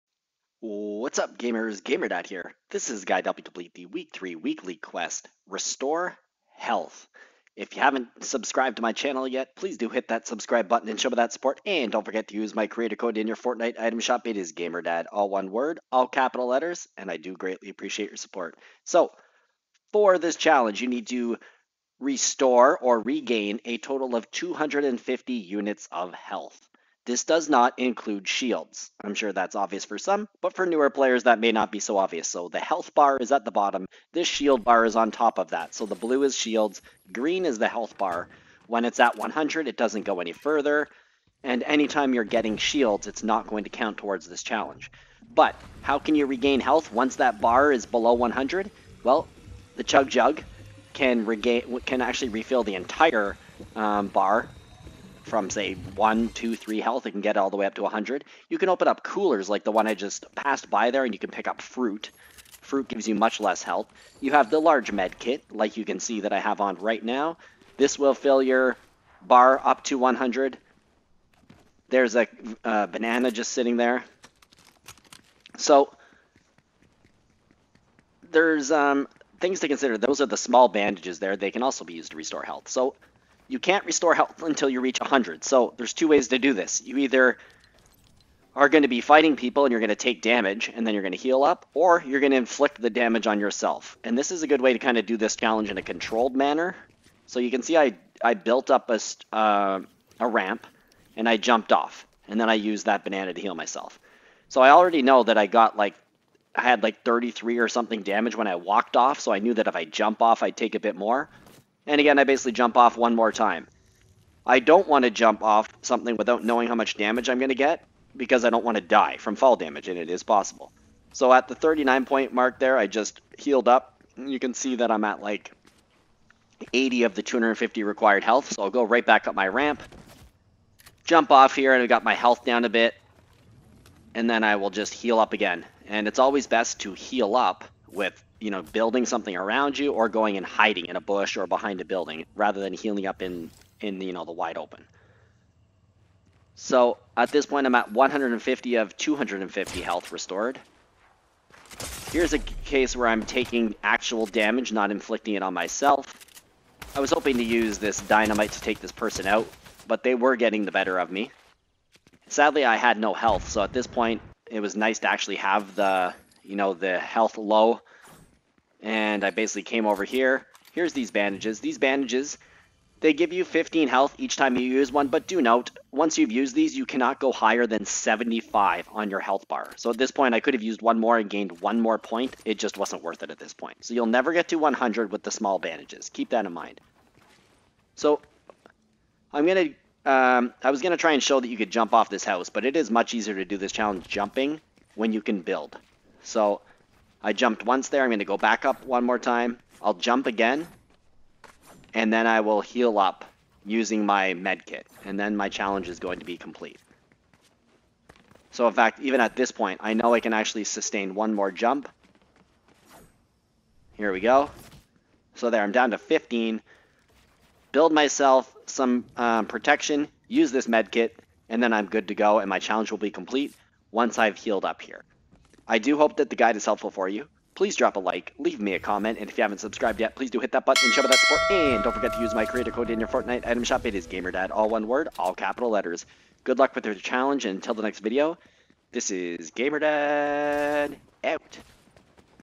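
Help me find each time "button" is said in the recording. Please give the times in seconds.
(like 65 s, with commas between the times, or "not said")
10 s, 230 s.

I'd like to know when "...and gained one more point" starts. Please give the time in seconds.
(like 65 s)
181 s.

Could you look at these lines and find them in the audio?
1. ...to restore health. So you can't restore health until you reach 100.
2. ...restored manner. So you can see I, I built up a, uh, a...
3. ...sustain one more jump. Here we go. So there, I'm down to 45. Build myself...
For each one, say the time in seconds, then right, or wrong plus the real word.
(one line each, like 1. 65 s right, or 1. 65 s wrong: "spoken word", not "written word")
1. 82 s right
2. 95 s wrong: "controlled", not "restored"
3. 210 s wrong: "15", not "45".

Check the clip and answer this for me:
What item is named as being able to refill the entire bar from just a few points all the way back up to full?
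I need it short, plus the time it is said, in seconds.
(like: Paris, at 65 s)
Chug Jug, at 49 s.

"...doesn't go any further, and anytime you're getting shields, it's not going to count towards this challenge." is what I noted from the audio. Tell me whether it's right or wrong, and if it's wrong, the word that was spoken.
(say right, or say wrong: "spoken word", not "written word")
right.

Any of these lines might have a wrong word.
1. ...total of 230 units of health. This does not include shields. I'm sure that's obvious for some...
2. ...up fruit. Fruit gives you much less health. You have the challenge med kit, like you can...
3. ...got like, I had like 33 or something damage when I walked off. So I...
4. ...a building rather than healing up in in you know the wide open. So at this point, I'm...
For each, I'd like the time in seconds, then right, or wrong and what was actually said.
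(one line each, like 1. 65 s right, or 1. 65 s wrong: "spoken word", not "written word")
1. 23 s wrong: "250", not "230"
2. 61 s wrong: "large", not "challenge"
3. 105 s right
4. 141 s right.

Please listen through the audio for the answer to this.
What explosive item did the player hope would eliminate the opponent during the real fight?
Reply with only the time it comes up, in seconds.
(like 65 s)
158 s.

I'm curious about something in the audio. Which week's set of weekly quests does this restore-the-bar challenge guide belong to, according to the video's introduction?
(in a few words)
Week 3.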